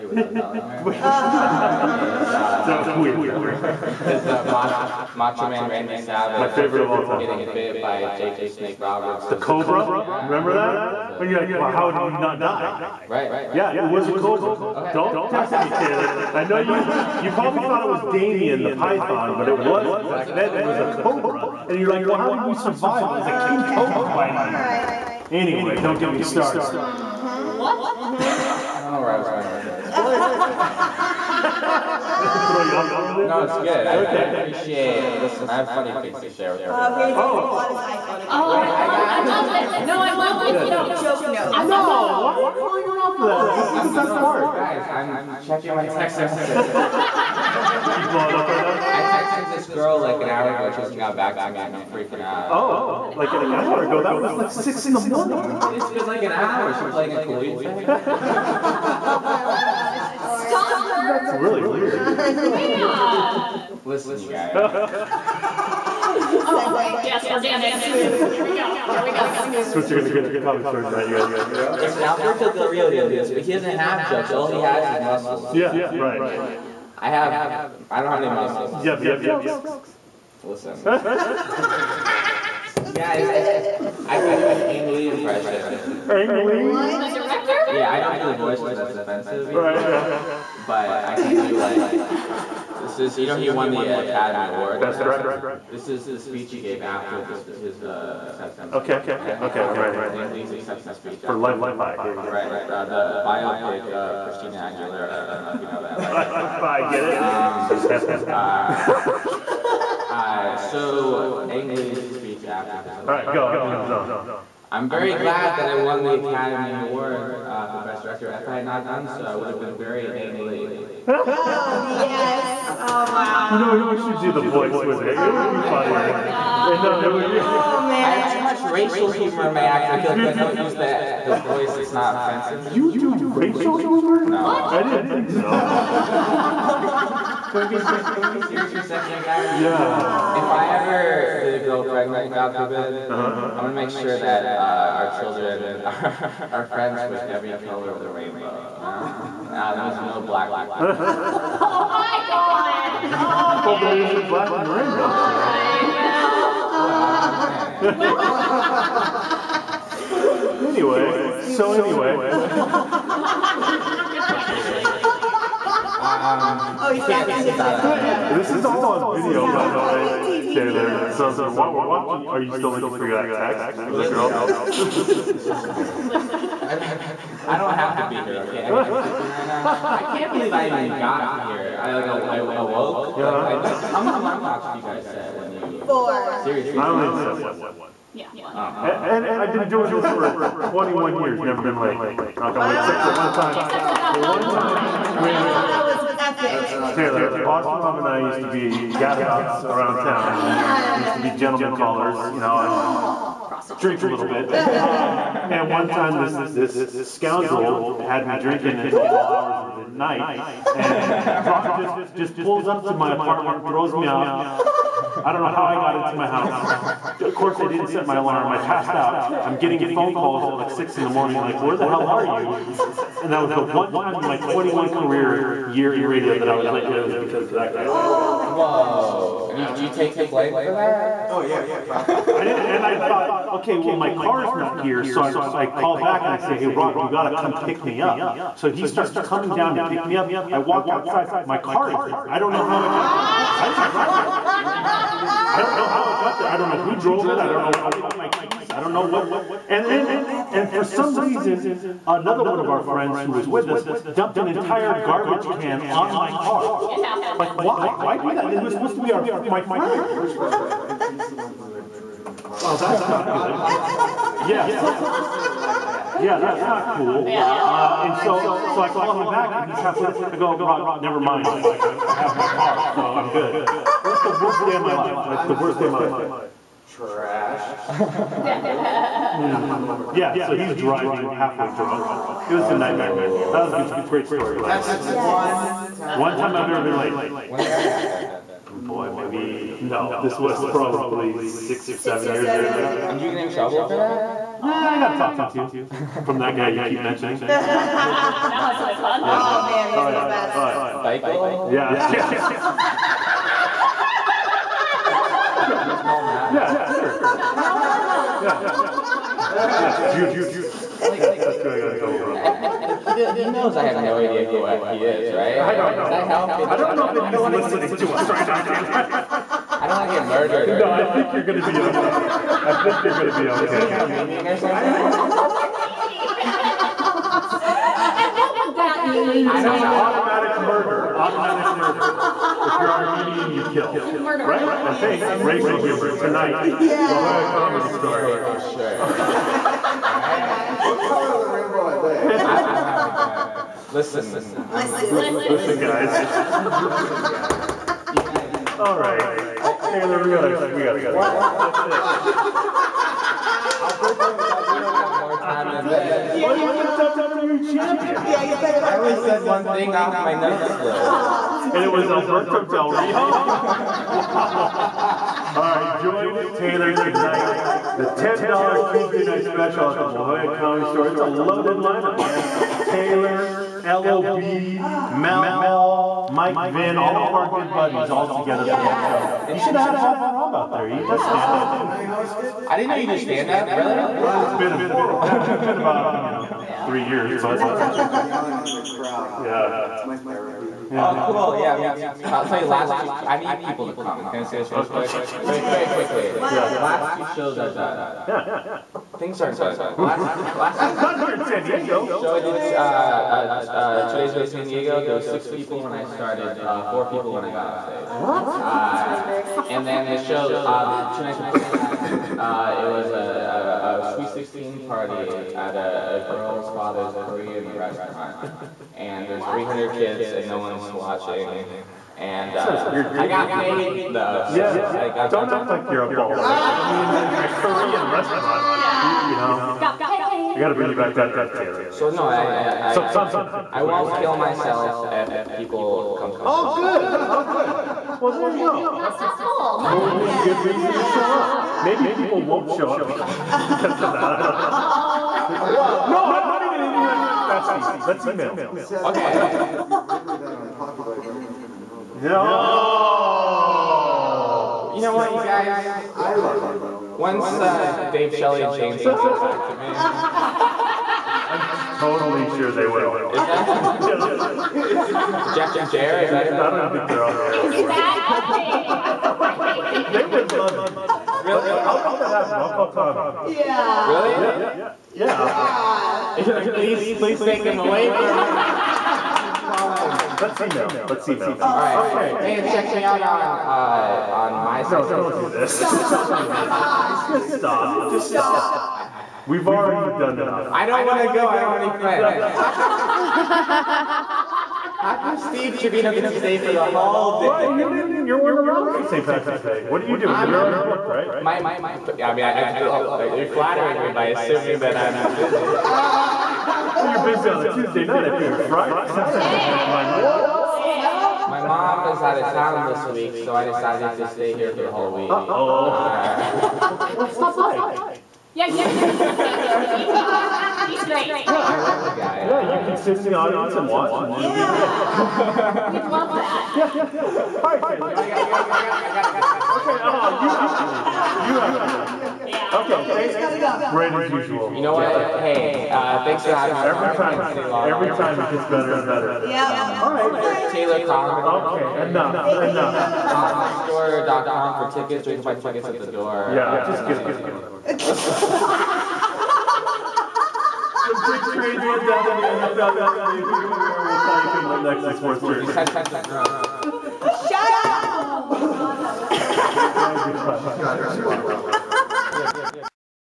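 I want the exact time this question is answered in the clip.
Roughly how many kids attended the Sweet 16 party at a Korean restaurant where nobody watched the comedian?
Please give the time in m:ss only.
6:59.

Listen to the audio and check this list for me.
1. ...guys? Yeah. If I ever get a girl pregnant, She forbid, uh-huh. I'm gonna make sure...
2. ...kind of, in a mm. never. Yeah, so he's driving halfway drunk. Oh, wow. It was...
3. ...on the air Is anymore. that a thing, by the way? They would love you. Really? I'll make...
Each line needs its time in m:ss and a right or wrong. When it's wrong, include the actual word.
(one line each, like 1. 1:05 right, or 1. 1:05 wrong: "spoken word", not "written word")
1. 2:19 wrong: "God", not "She"
2. 4:37 wrong: "hungover", not "never"
3. 7:47 right.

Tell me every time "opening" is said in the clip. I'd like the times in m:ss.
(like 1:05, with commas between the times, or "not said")
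not said.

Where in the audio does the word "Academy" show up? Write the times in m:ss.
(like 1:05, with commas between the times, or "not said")
1:33, 1:56.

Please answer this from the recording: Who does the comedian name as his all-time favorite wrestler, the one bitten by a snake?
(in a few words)
Macho Man Randy Savage.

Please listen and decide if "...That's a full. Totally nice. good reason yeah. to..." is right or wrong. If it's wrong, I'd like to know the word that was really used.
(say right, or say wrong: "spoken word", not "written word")
right.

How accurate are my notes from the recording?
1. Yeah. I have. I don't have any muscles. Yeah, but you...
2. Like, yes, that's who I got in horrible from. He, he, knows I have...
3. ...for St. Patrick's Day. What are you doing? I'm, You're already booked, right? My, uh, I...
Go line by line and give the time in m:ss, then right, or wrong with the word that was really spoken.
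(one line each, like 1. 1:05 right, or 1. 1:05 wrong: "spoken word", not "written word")
1. 1:16 right
2. 5:11 wrong: "trouble", not "horrible"
3. 8:18 right.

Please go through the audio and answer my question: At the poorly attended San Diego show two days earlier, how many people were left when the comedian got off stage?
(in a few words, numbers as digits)
4.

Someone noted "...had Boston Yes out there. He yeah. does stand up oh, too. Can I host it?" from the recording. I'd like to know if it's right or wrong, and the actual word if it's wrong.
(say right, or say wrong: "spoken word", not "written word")
wrong: "Rob", not "Yes".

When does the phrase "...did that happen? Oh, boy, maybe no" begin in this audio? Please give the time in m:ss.
4:47.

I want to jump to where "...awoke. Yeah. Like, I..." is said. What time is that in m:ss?
3:02.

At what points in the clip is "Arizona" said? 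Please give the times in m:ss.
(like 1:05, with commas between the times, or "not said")
not said.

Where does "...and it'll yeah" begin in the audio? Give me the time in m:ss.
8:44.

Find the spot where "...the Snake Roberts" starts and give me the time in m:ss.
0:08.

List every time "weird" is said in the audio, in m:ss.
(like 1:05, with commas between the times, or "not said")
0:02, 1:01.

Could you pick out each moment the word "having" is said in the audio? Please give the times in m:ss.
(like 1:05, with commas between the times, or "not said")
8:56.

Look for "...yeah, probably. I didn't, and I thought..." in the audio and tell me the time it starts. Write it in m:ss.
3:51.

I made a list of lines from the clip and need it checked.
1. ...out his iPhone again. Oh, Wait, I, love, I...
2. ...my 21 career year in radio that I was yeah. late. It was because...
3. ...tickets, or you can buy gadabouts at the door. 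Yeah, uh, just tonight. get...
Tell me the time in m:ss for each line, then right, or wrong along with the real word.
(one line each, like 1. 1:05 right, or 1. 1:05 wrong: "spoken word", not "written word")
1. 0:37 right
2. 3:44 right
3. 9:04 wrong: "tickets", not "gadabouts".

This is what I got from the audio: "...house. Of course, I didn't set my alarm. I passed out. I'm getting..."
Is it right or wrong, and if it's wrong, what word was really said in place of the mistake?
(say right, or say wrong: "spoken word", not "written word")
right.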